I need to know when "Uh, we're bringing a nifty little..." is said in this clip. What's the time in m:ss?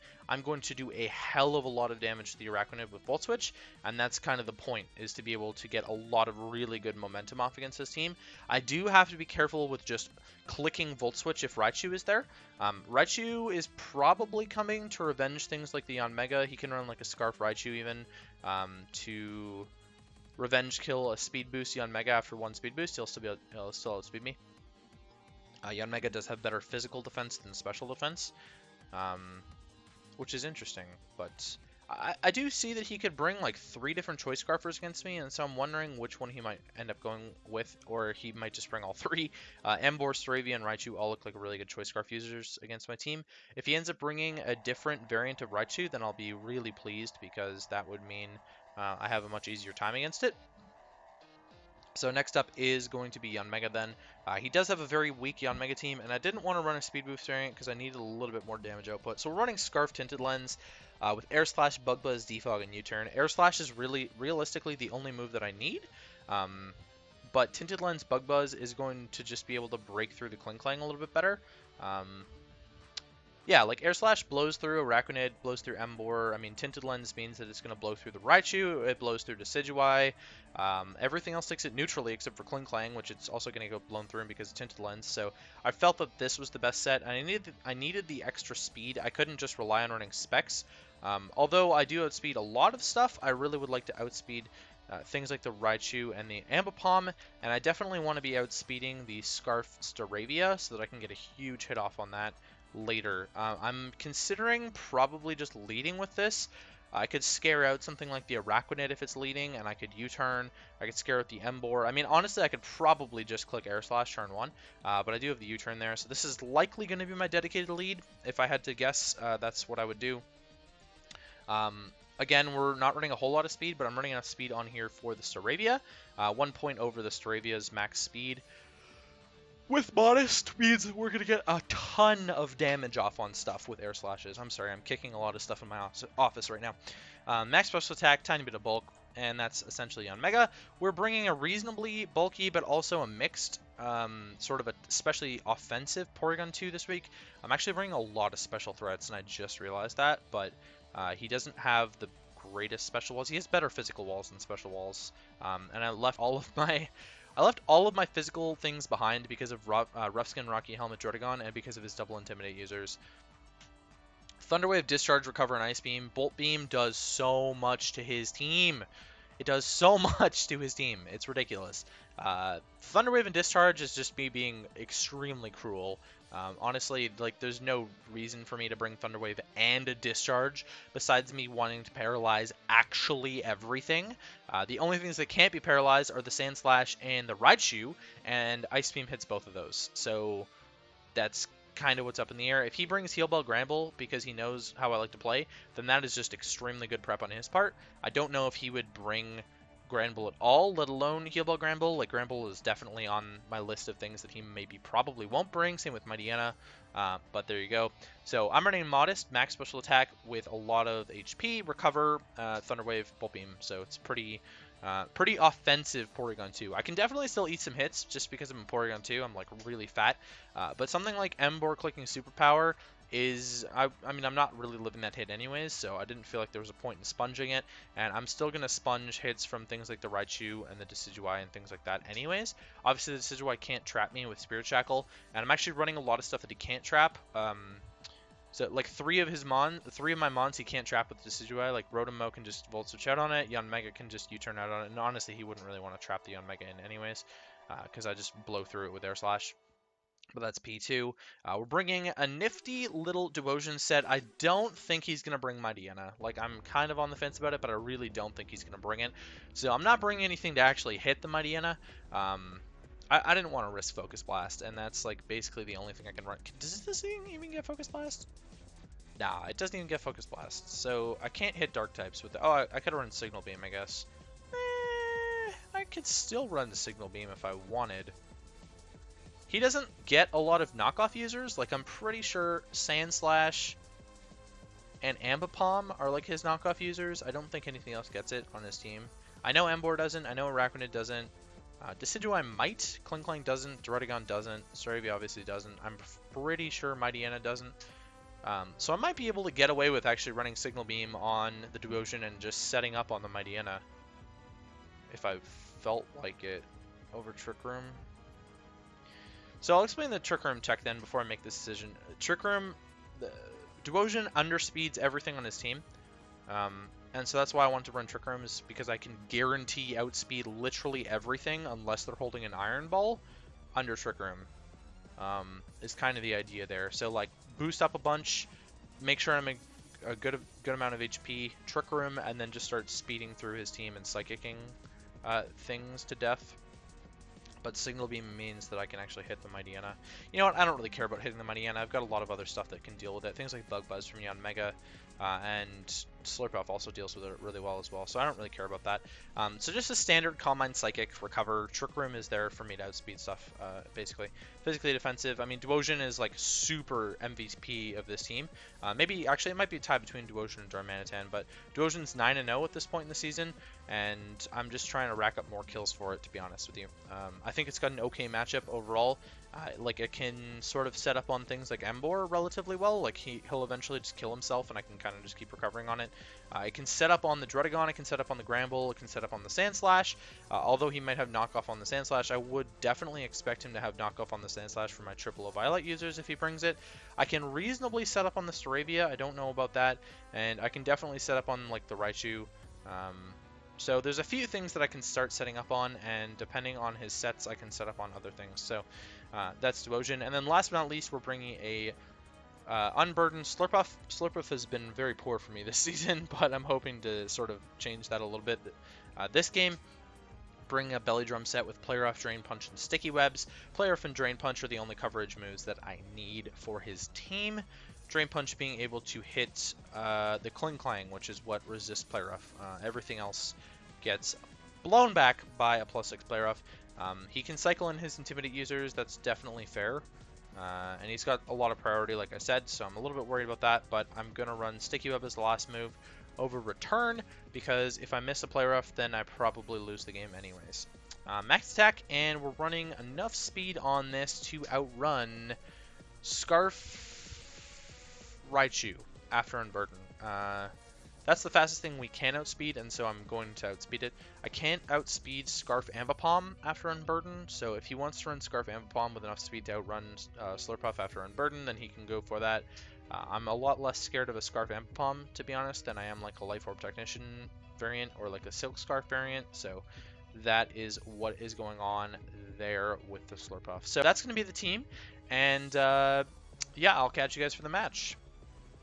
4:11.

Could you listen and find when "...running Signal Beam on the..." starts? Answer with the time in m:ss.
5:00.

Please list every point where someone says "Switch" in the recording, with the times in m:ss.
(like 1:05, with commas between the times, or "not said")
0:03, 0:11, 4:02.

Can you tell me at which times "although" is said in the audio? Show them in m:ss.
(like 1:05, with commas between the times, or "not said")
1:31, 6:20.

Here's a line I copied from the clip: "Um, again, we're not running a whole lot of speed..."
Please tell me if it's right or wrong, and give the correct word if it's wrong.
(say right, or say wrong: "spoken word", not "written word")
right.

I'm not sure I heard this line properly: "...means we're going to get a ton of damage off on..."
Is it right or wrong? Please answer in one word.
right.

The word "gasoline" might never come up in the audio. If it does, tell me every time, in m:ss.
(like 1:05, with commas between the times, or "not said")
not said.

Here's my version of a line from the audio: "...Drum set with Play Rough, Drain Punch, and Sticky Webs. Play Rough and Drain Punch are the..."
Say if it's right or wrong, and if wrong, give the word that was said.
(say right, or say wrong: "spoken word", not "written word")
right.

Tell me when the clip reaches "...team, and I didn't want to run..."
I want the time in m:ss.
0:55.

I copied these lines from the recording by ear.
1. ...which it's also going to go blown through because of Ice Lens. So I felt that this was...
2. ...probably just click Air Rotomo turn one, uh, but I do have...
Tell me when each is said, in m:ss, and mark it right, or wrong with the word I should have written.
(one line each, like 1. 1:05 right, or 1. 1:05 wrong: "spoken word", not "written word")
1. 1:22 wrong: "Tinted", not "Ice"
2. 1:52 wrong: "Slash", not "Rotomo".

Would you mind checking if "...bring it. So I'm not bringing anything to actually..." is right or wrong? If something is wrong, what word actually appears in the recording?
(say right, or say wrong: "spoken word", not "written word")
right.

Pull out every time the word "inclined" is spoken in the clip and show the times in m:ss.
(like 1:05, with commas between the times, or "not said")
not said.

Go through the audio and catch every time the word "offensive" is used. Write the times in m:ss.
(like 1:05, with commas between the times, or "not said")
2:25, 3:35.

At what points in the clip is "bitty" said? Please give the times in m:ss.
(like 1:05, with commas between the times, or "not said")
not said.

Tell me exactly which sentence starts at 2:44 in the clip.
Thunderwave, Discharge, Recover, and Ice Beam.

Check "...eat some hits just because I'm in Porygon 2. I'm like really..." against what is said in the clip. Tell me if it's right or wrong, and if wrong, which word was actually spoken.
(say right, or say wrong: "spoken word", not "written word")
right.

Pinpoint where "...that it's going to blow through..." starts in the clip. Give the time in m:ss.
1:17.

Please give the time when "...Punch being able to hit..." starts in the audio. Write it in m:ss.
6:58.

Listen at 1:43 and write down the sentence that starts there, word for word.
Uh, I'm considering probably just leading with this.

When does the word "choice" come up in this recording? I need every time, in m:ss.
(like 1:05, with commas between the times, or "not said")
0:34, 0:41.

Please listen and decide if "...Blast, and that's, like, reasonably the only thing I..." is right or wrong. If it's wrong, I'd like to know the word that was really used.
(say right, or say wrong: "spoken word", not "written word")
wrong: "basically", not "reasonably".